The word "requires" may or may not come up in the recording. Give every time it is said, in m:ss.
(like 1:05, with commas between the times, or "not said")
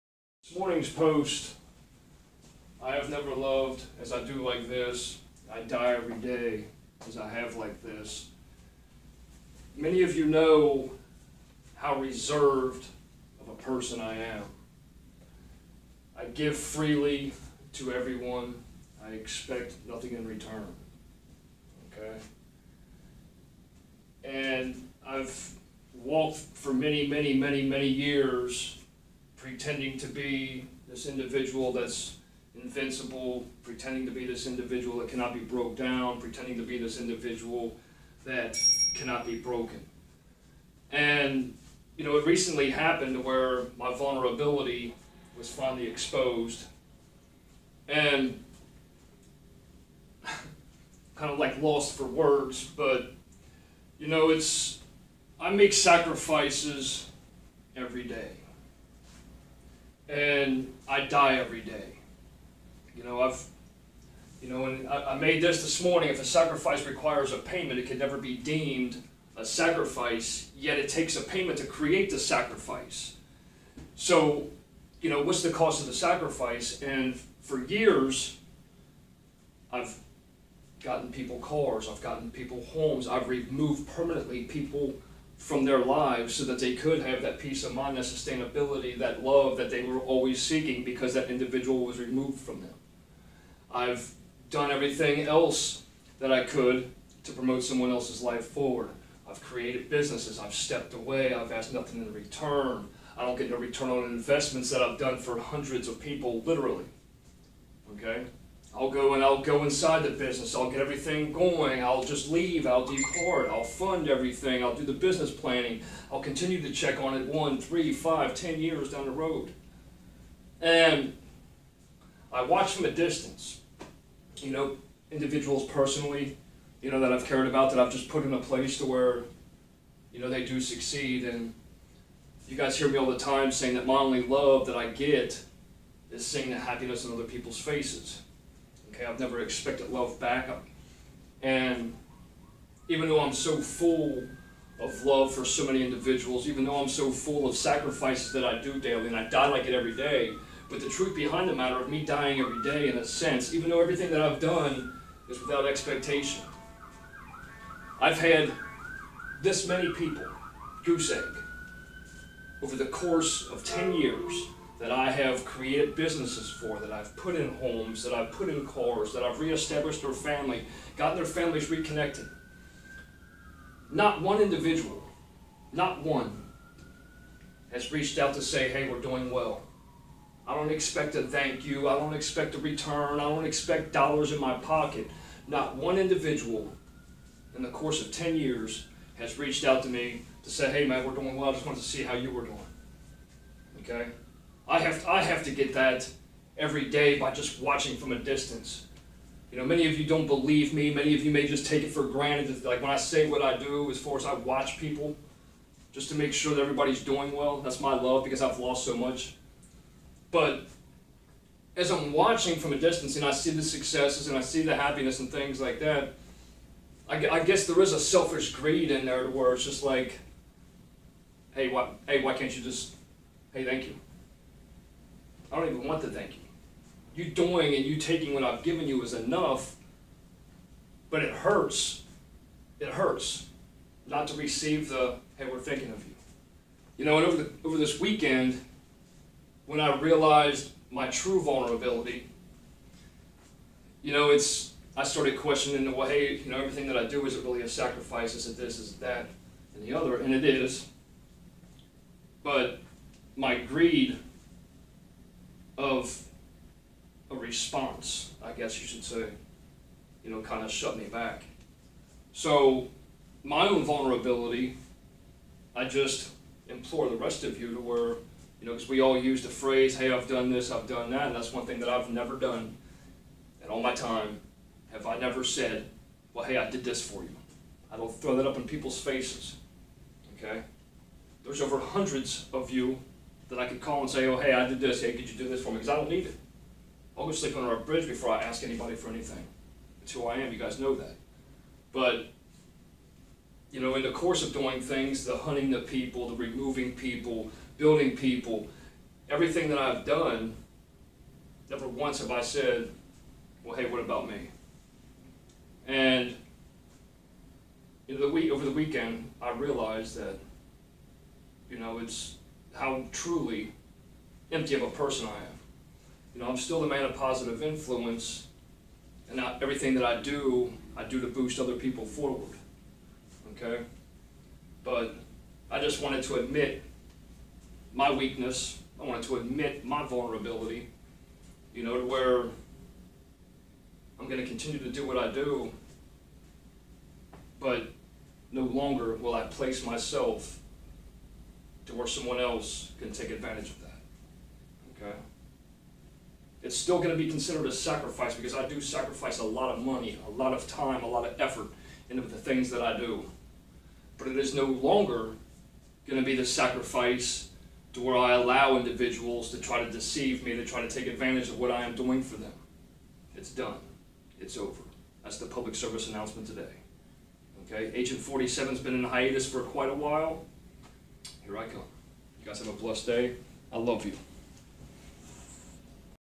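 1:06.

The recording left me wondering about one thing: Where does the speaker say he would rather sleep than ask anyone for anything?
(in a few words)
under a bridge.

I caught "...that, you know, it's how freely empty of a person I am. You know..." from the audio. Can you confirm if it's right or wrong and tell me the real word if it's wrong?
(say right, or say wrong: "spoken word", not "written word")
wrong: "truly", not "freely".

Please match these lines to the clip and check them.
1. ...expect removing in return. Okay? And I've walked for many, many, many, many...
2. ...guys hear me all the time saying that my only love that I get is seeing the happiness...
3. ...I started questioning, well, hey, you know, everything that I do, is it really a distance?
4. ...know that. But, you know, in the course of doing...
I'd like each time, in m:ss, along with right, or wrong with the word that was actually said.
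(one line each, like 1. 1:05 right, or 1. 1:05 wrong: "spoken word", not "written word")
1. 0:19 wrong: "nothing", not "removing"
2. 2:12 right
3. 4:04 wrong: "sacrifice", not "distance"
4. 4:50 right.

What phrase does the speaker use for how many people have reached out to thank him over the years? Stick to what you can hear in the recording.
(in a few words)
goose egg.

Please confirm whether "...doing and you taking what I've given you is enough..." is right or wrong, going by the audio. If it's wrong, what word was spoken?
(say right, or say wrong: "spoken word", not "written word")
right.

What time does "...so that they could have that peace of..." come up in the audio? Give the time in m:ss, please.
1:26.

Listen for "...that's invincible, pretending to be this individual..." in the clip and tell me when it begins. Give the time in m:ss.
0:31.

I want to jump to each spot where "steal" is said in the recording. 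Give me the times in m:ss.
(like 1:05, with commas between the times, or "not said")
not said.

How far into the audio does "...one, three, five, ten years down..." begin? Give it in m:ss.
1:57.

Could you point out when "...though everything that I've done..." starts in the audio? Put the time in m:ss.
2:33.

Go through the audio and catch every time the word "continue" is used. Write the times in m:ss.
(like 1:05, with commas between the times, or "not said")
1:56, 5:34.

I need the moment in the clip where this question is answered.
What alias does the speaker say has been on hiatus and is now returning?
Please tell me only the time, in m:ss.
6:07.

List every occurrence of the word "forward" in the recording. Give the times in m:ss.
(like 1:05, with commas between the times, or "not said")
1:38, 5:22.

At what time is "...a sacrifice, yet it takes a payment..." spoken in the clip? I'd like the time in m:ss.
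1:09.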